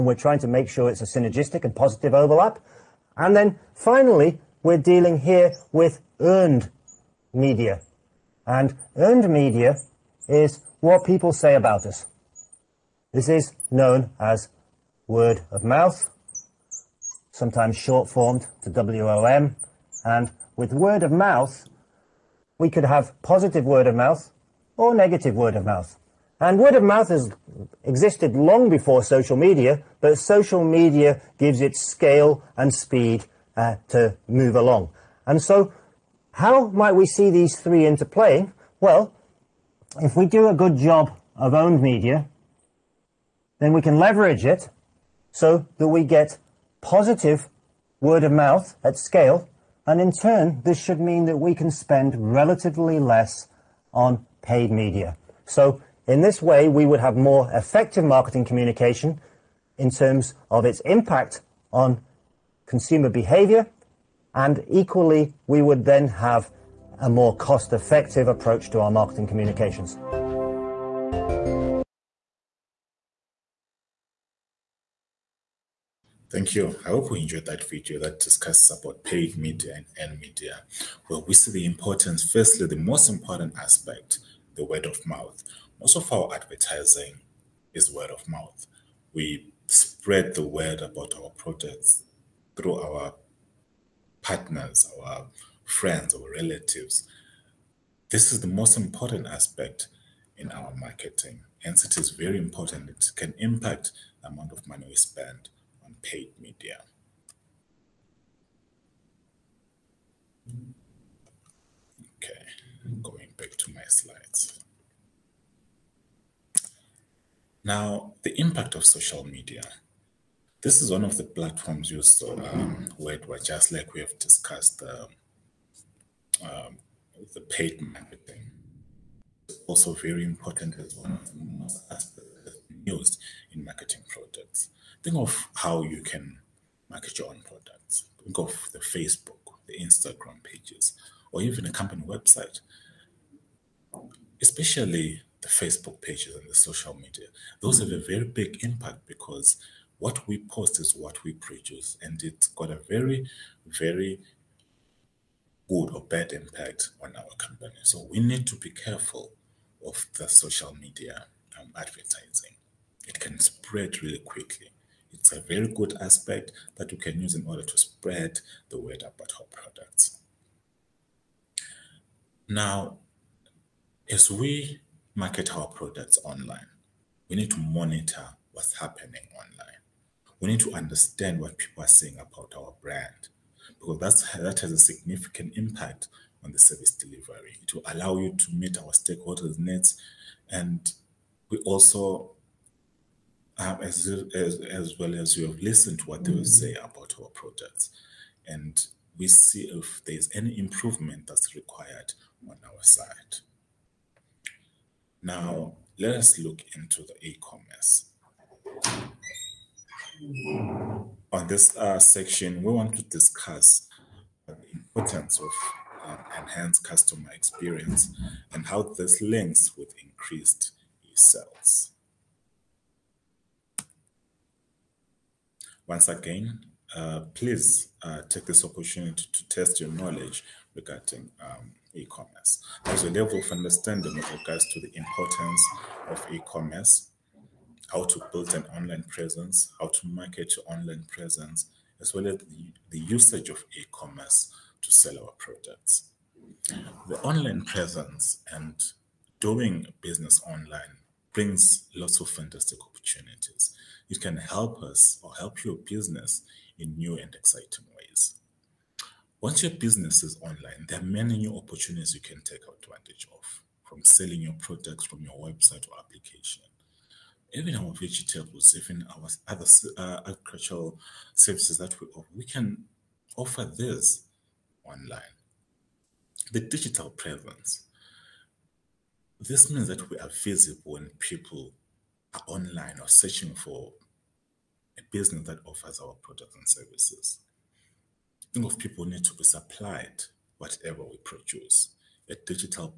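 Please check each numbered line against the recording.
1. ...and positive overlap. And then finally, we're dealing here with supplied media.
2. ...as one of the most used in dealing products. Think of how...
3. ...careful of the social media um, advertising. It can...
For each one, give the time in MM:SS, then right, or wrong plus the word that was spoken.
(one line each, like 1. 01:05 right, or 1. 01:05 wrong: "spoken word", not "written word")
1. 00:01 wrong: "earned", not "supplied"
2. 02:10 wrong: "marketing", not "dealing"
3. 02:38 right.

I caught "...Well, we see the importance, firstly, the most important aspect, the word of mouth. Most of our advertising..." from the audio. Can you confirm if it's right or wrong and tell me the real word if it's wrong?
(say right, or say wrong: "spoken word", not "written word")
right.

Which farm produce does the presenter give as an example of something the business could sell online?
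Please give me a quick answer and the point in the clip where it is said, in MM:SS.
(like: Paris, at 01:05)
vegetables, at 04:27.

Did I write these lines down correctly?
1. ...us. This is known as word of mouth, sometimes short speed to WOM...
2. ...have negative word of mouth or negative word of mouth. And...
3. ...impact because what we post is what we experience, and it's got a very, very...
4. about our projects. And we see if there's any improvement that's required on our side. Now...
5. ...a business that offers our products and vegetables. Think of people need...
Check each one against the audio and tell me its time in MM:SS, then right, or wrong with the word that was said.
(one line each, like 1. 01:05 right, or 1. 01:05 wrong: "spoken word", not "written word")
1. 00:11 wrong: "formed", not "speed"
2. 00:22 wrong: "positive", not "negative"
3. 02:28 wrong: "produce", not "experience"
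4. 03:16 right
5. 04:44 wrong: "services", not "vegetables".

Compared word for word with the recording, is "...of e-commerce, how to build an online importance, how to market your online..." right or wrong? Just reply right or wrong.
wrong.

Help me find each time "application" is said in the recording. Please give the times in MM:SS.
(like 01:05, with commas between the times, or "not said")
04:25.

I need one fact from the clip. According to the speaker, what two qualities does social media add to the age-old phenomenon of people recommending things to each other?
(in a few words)
scale and speed.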